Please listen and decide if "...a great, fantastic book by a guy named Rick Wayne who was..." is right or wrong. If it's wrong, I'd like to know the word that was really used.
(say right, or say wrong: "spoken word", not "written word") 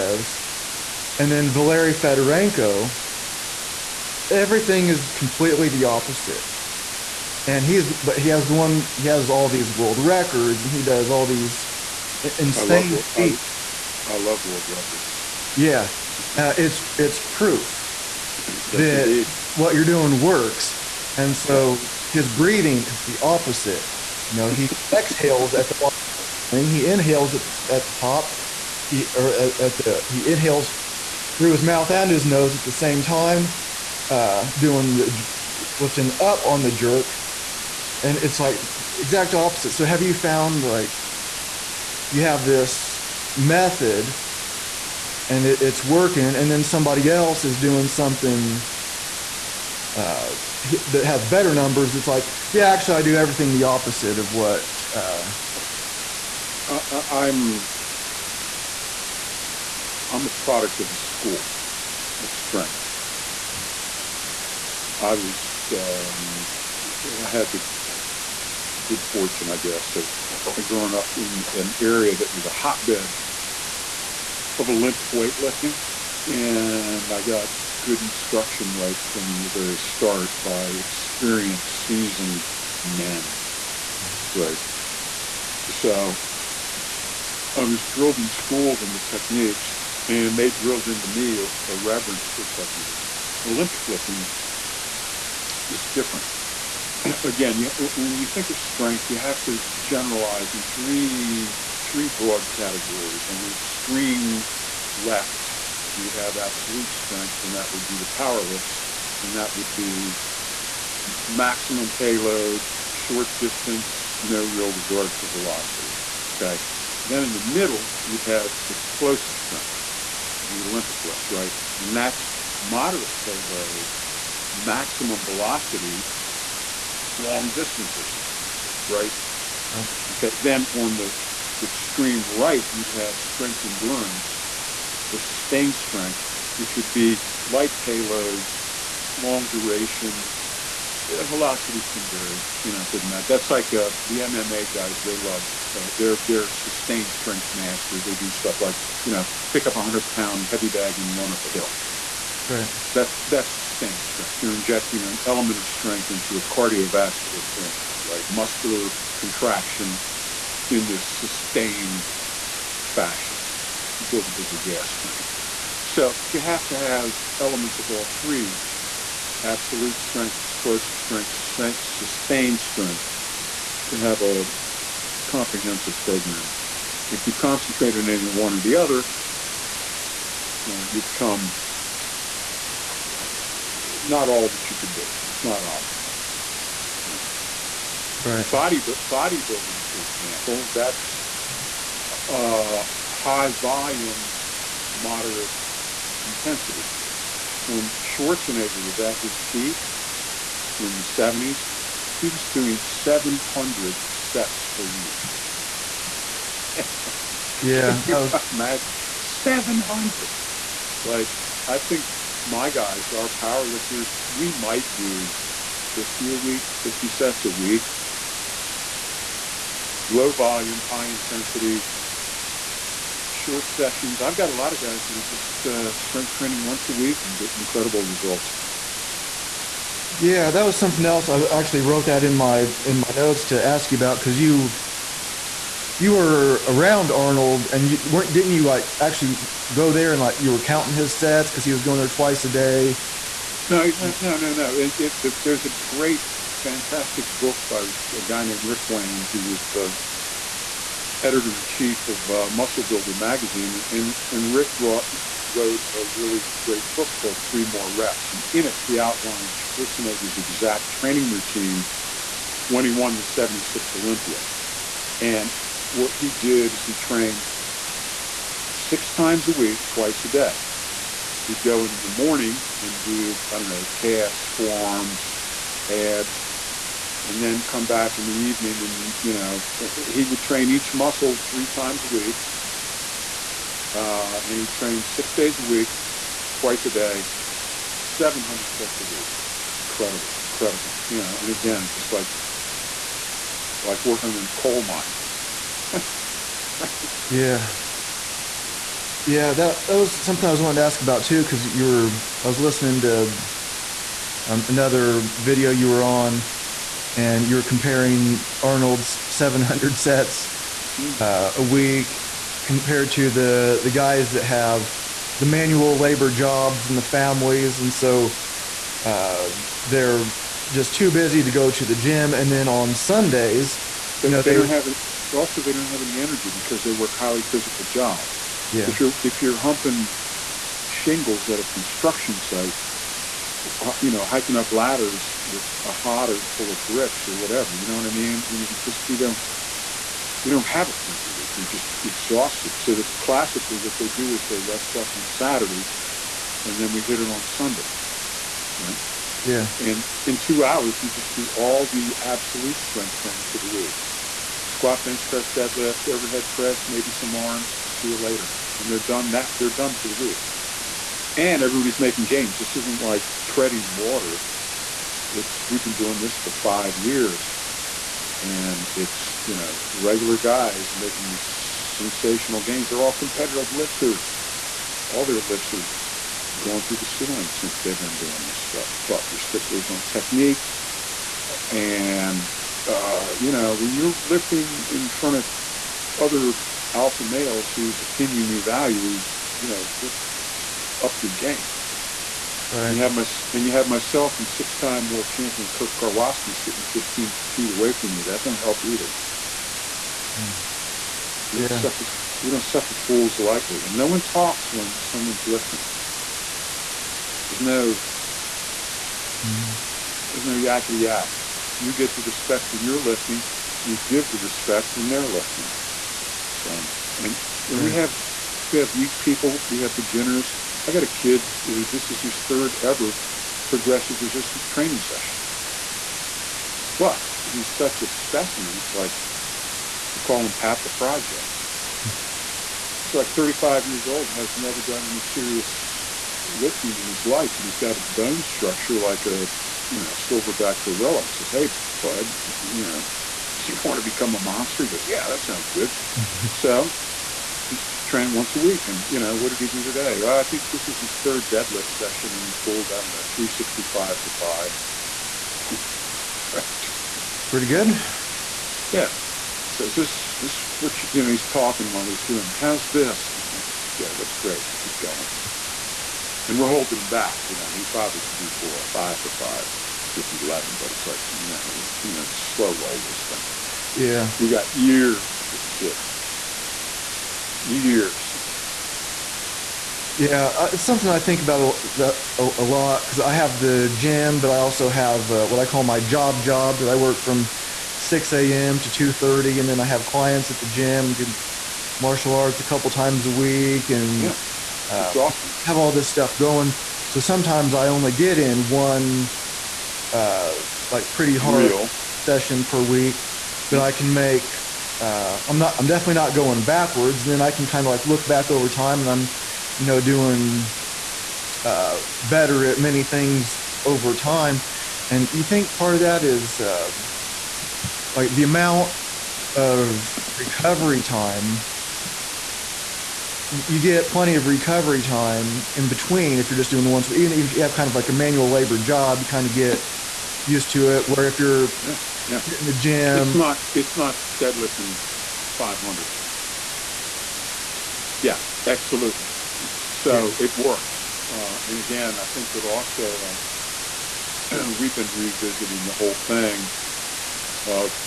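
right.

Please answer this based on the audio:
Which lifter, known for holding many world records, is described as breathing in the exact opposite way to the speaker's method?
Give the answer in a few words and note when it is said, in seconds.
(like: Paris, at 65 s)
Valery Fedorenko, at 1 s.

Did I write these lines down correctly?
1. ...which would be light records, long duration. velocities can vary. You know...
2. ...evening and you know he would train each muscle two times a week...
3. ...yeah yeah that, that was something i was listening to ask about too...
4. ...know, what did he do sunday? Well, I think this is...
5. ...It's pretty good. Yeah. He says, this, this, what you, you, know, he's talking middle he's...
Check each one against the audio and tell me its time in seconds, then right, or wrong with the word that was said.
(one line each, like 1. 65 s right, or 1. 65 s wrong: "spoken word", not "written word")
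1. 136 s wrong: "payloads", not "records"
2. 278 s wrong: "three", not "two"
3. 297 s wrong: "wanting", not "listening"
4. 449 s wrong: "today", not "sunday"
5. 457 s wrong: "while", not "middle".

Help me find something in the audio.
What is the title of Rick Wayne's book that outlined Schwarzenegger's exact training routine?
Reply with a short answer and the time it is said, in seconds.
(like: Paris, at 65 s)
Three More Reps, at 257 s.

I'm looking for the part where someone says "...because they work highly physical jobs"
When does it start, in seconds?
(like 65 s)
326 s.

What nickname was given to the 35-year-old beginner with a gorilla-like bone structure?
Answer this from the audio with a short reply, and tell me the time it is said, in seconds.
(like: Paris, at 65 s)
Pat the Project, at 430 s.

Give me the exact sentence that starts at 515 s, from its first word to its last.
And you think part of that is uh, like the amount of recovery time.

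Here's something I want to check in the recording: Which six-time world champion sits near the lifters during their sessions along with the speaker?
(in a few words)
Kirk Karwoski.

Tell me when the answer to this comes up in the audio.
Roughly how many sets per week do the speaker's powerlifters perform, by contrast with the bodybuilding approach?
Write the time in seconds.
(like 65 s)
216 s.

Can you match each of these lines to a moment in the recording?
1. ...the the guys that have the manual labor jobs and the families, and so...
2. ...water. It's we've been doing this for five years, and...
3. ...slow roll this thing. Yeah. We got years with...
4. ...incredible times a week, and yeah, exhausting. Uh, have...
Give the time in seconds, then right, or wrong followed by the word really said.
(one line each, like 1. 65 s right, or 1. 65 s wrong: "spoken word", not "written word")
1. 313 s right
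2. 363 s right
3. 472 s right
4. 492 s wrong: "couple", not "incredible".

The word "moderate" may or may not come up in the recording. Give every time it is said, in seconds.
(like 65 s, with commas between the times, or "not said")
122 s, 194 s.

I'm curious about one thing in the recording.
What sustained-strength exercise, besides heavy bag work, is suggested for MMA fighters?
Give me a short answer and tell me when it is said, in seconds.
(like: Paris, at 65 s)
run up a hill, at 151 s.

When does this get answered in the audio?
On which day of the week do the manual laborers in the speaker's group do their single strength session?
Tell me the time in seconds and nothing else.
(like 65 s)
347 s.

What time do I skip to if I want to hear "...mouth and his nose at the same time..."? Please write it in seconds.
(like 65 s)
31 s.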